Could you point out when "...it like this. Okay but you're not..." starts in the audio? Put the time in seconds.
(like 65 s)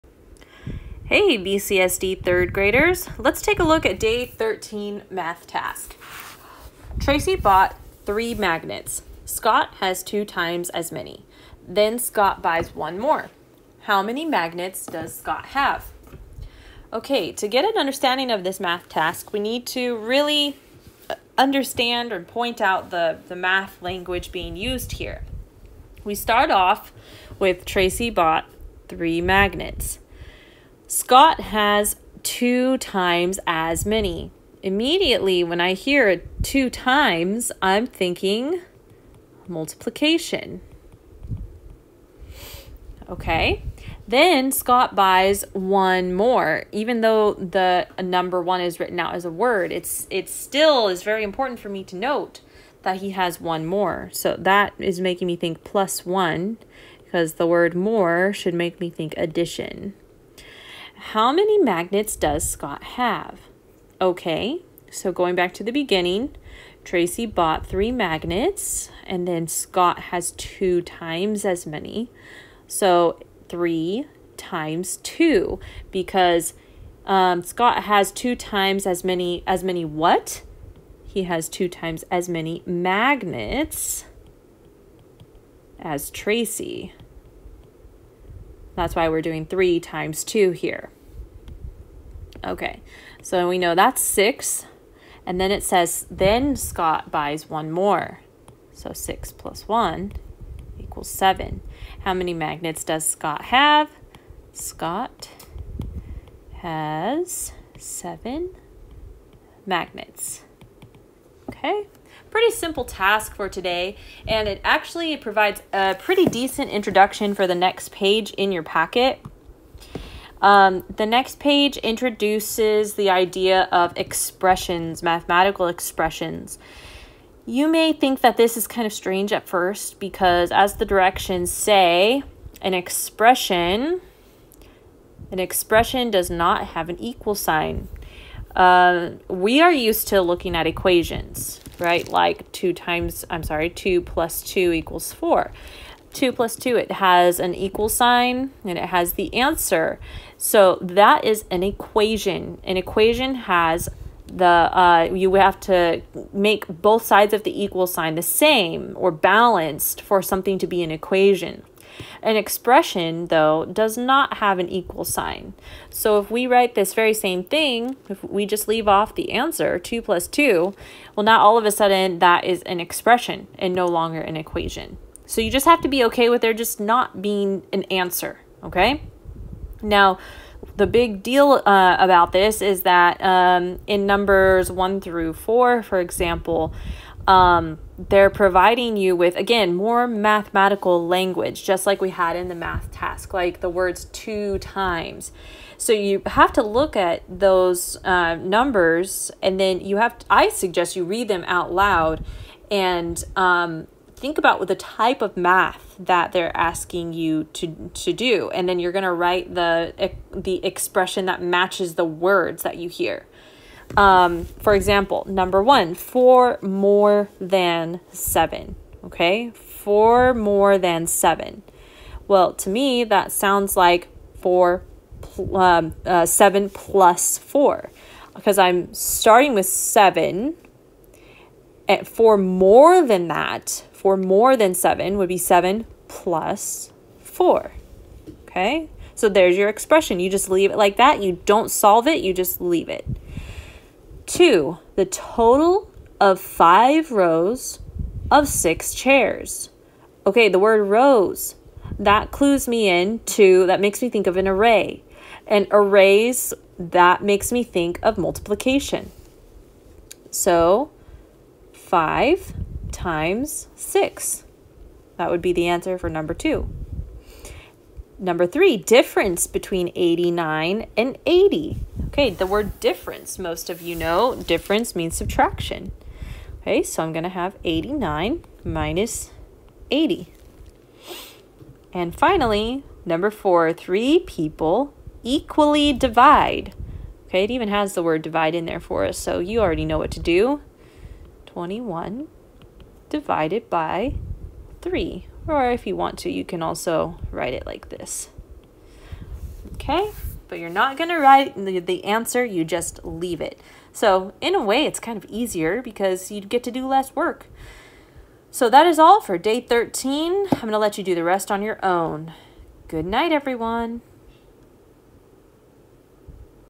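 297 s.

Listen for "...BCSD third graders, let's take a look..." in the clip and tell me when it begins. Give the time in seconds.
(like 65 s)
1 s.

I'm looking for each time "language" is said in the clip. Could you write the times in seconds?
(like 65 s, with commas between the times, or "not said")
23 s, 191 s.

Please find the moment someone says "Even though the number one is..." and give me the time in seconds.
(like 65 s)
46 s.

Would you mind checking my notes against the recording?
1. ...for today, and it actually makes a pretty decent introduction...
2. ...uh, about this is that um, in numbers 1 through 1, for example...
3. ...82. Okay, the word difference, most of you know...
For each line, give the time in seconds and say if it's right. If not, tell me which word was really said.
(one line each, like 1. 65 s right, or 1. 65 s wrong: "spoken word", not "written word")
1. 113 s wrong: "provides", not "makes"
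2. 181 s wrong: "4", not "1"
3. 271 s wrong: "80", not "82".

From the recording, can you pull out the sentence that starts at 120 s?
Um, the next page introduces the idea of expressions, mathematical expressions.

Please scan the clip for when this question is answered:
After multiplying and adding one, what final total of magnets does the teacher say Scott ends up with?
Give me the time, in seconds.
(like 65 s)
104 s.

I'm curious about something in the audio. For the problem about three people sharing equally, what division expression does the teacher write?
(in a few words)
21 divided by 3.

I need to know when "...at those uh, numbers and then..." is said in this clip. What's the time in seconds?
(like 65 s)
196 s.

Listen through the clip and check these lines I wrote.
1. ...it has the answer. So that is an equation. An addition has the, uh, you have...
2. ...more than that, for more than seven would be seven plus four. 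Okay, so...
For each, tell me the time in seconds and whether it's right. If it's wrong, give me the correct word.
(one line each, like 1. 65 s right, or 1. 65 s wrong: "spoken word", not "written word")
1. 148 s wrong: "equation", not "addition"
2. 232 s right.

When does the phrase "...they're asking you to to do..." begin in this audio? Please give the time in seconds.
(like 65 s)
206 s.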